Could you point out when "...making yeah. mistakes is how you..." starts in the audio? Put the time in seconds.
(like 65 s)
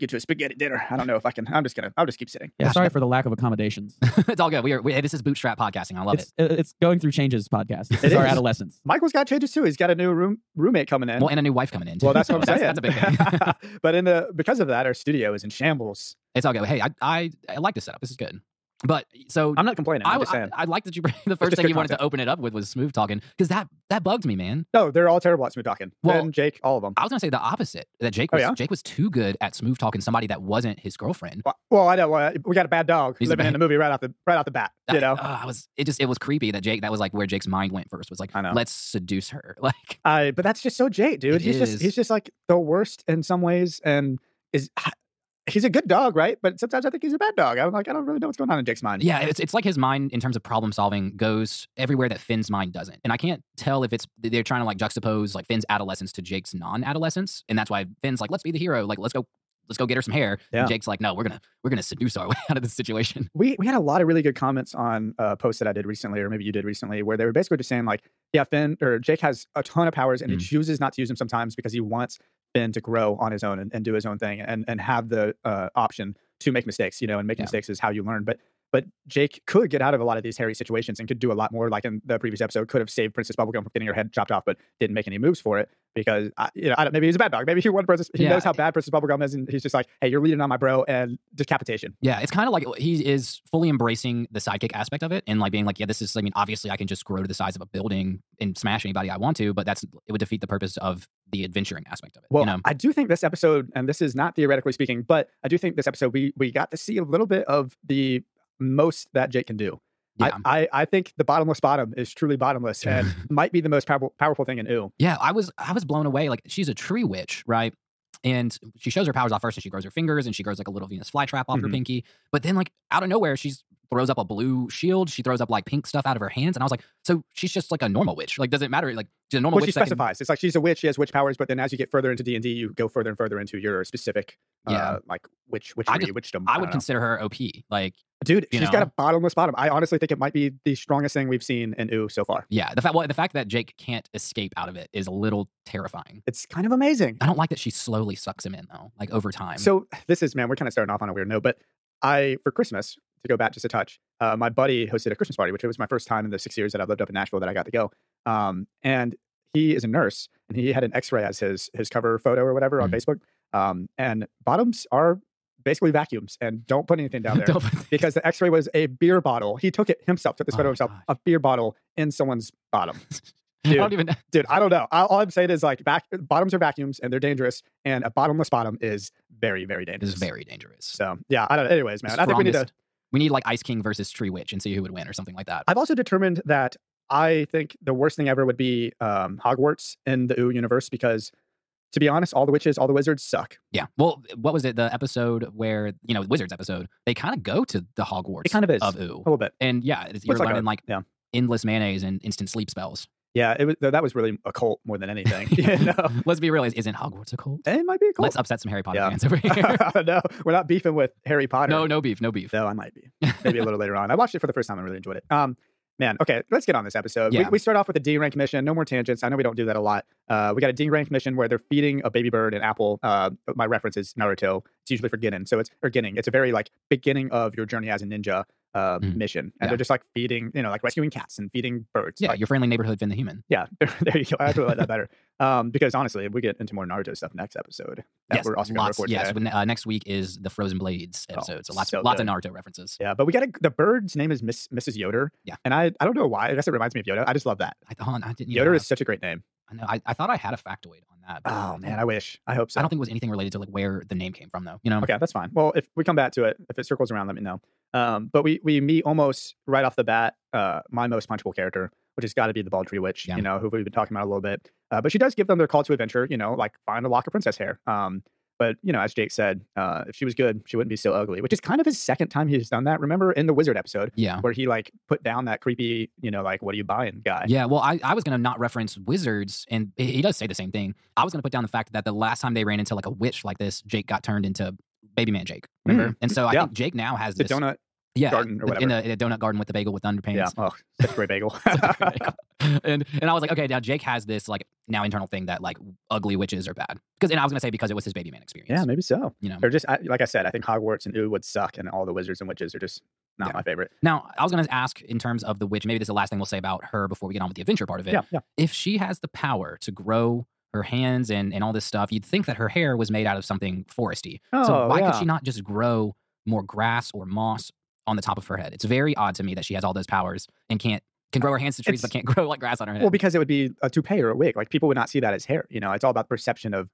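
77 s.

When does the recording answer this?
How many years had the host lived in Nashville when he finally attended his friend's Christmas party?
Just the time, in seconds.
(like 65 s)
156 s.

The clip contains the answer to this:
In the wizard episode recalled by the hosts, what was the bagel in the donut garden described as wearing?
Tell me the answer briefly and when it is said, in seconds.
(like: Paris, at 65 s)
Underpants, at 290 s.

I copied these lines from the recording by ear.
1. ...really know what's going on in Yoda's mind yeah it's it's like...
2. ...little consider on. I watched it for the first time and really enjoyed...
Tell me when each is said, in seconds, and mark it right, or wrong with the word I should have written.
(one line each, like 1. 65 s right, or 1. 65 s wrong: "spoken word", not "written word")
1. 48 s wrong: "Jake", not "Yoda"
2. 213 s wrong: "later", not "consider".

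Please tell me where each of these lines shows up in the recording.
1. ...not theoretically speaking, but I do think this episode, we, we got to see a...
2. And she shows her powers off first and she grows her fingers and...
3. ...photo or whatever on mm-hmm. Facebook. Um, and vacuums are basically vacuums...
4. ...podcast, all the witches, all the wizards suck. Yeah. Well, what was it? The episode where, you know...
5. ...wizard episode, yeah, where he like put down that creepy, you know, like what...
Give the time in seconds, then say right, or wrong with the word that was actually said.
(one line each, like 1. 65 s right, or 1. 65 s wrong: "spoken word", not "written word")
1. 104 s right
2. 118 s right
3. 162 s wrong: "bottoms", not "vacuums"
4. 192 s wrong: "honest", not "podcast"
5. 273 s right.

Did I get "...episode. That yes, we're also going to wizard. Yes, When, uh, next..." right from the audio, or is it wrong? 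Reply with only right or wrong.
wrong.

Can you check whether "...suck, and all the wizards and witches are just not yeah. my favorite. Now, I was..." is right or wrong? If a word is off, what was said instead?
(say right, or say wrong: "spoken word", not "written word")
right.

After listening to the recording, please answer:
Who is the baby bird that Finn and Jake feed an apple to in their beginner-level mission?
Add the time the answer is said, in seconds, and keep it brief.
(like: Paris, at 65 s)
Mrs. Yoder, at 244 s.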